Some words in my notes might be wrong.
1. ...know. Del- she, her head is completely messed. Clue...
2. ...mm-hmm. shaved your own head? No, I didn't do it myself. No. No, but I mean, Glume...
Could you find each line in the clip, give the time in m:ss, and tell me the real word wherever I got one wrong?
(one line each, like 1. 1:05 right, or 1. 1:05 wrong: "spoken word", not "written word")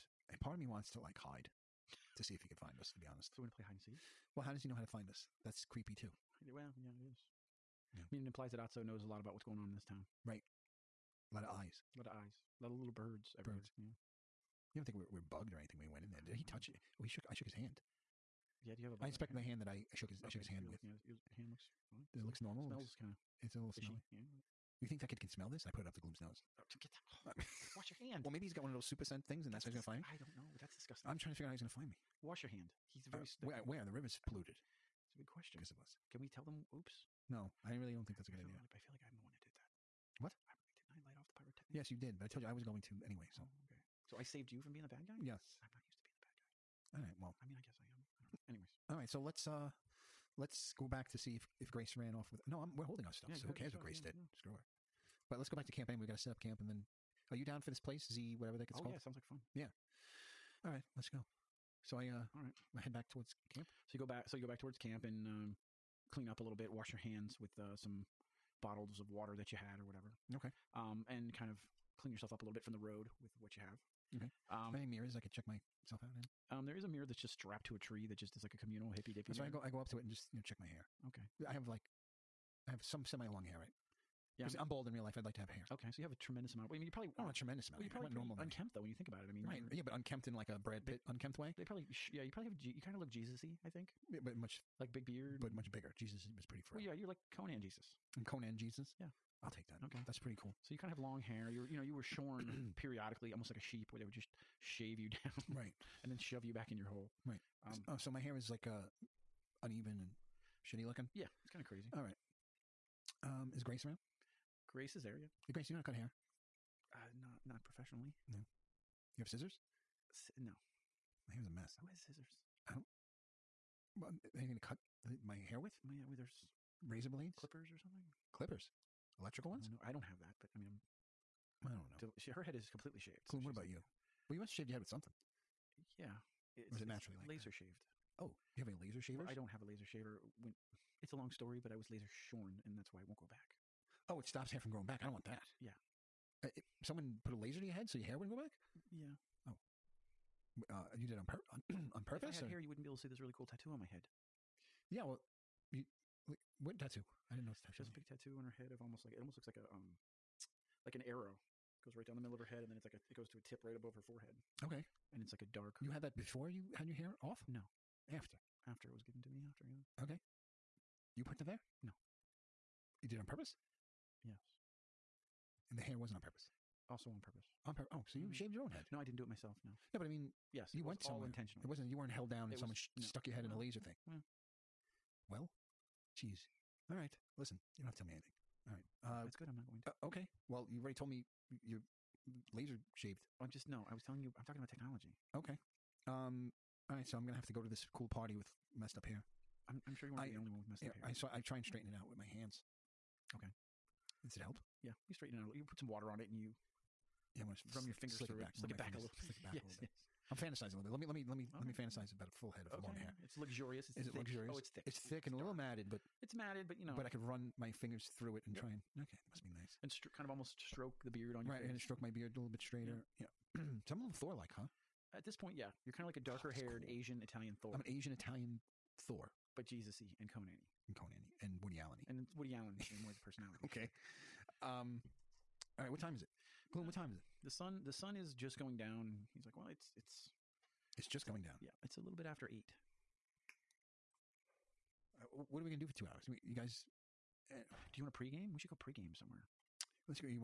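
1. 2:11 wrong: "shaved", not "messed"
2. 2:58 wrong: "Yes", not "Glume".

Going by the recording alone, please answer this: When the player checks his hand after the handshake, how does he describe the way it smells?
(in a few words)
fishy.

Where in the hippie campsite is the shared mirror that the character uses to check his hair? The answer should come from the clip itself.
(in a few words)
strapped to a tree.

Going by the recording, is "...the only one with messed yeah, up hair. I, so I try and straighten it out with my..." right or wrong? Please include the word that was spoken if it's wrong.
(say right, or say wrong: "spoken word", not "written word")
right.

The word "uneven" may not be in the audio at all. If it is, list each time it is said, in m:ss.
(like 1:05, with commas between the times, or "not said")
1:49.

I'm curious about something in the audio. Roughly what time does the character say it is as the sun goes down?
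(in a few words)
a little after 8.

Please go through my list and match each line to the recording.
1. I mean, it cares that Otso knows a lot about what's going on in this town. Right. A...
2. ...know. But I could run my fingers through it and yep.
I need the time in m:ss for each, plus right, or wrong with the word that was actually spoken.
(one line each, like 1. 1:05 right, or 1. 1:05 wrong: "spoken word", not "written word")
1. 0:08 wrong: "implies", not "cares"
2. 3:36 right.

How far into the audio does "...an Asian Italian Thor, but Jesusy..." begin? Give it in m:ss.
3:47.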